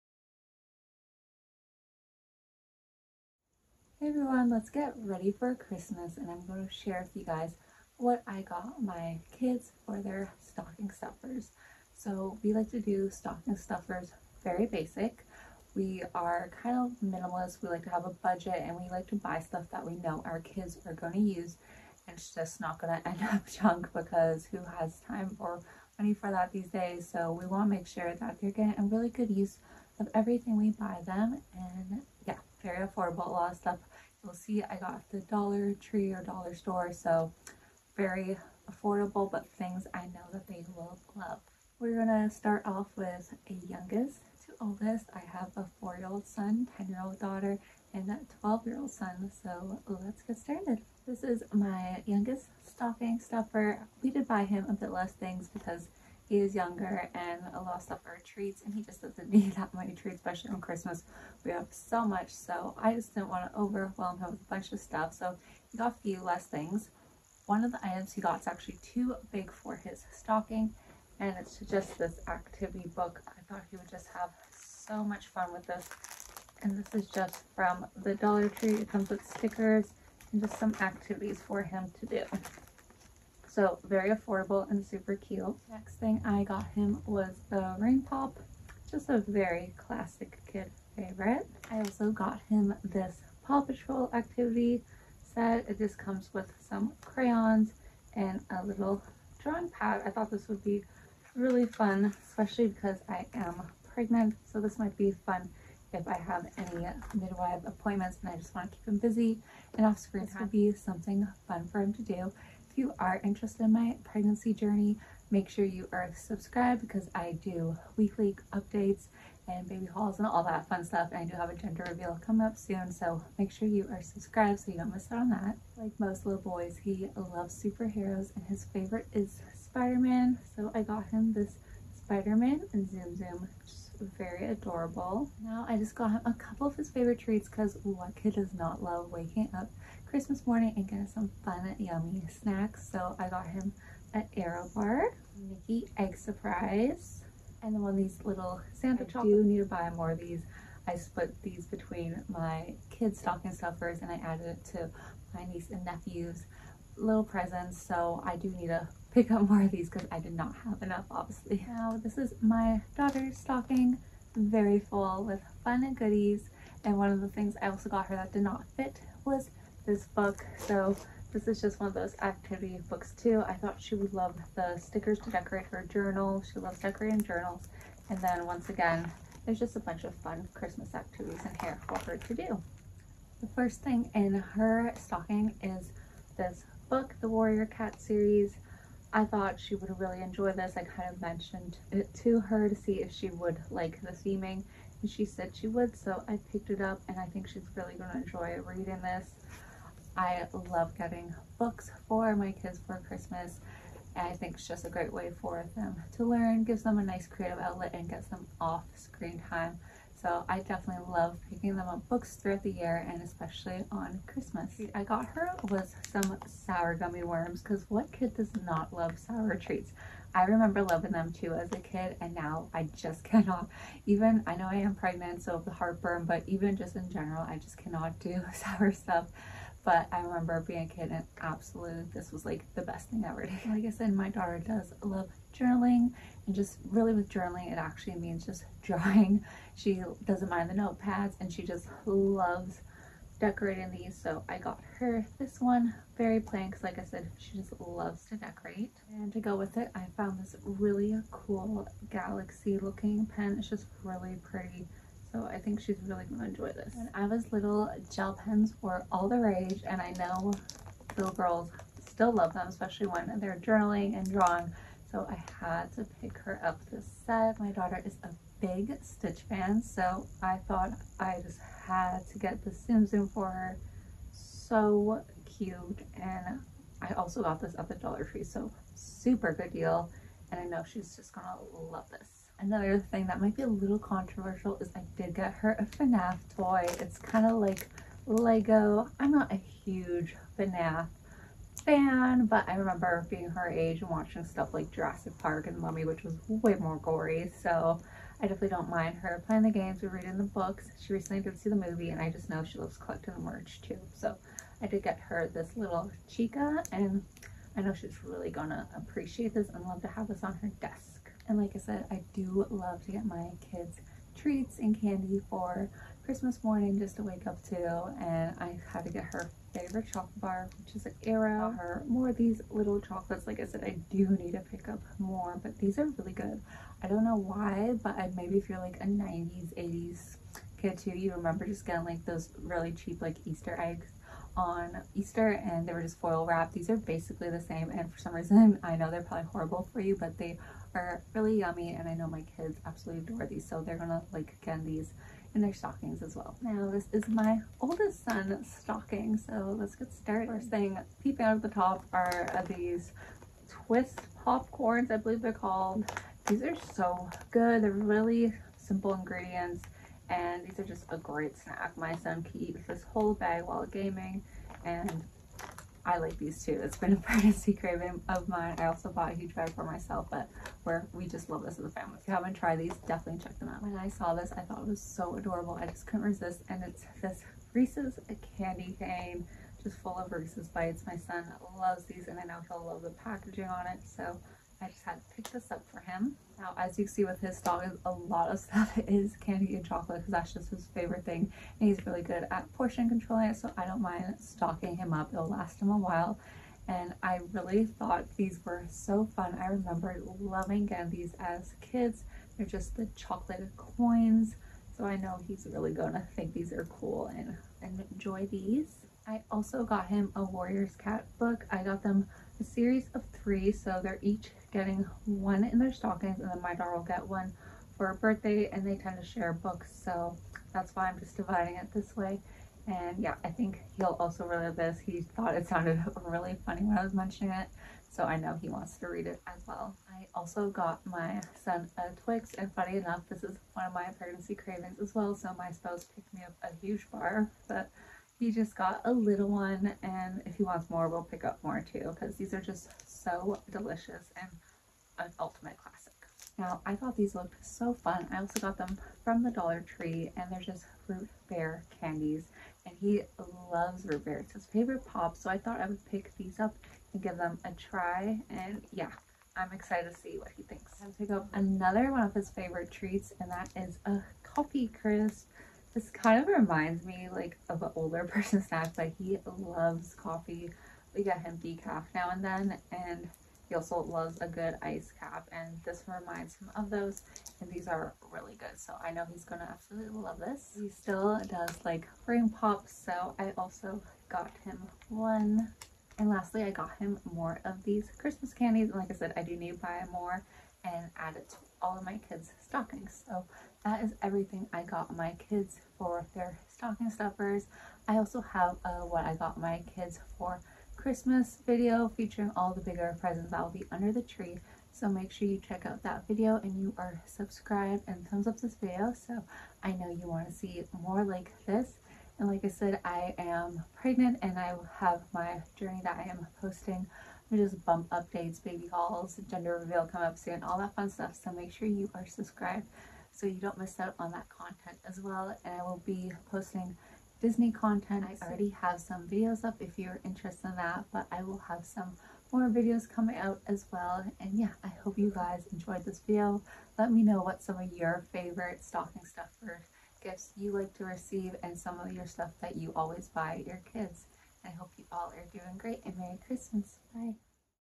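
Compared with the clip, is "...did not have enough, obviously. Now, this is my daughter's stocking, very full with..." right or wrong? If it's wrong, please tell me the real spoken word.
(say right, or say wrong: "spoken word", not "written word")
right.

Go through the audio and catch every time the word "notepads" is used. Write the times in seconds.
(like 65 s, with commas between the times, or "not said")
240 s.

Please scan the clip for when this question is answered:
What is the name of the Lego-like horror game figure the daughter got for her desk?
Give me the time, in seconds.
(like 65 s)
306 s.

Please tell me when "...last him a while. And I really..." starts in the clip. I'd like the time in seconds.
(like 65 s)
395 s.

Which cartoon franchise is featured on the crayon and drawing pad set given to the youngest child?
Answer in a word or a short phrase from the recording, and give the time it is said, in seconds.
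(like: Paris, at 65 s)
Paw Patrol, at 93 s.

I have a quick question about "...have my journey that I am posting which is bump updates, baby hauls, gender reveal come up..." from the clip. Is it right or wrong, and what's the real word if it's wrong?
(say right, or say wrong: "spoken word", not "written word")
right.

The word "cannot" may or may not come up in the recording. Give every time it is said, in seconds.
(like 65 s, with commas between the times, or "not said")
223 s, 227 s.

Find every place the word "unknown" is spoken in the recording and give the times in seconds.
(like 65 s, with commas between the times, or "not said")
not said.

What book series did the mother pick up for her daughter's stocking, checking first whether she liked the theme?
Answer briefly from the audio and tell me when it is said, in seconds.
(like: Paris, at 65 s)
Warrior Cat series, at 187 s.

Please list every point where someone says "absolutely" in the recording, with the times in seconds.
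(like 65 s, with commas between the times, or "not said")
231 s, 342 s, 479 s.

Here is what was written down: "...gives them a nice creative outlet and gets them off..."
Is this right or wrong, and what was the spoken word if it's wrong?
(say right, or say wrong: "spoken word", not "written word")
right.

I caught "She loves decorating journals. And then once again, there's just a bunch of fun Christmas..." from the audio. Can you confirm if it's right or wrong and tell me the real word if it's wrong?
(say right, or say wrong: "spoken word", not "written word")
right.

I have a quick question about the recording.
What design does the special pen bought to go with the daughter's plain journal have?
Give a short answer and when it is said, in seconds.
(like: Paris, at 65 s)
galaxy, at 252 s.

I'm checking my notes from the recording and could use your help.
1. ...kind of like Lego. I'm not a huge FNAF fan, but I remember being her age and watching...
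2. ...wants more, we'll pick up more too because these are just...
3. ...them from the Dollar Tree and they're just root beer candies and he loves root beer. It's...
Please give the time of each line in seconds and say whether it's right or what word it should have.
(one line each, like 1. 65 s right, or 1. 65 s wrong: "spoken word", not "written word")
1. 287 s right
2. 440 s right
3. 448 s right.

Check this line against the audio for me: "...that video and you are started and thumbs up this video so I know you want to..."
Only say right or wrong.
wrong.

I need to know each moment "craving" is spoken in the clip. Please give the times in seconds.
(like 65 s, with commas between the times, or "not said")
367 s, 434 s.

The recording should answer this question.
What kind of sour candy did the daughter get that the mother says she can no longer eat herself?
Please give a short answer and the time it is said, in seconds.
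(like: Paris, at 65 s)
sour gummy worms, at 216 s.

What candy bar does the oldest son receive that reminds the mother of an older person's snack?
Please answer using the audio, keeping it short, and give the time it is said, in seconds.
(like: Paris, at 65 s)
Coffee Crisp, at 464 s.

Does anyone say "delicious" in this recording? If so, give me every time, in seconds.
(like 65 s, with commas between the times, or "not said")
443 s.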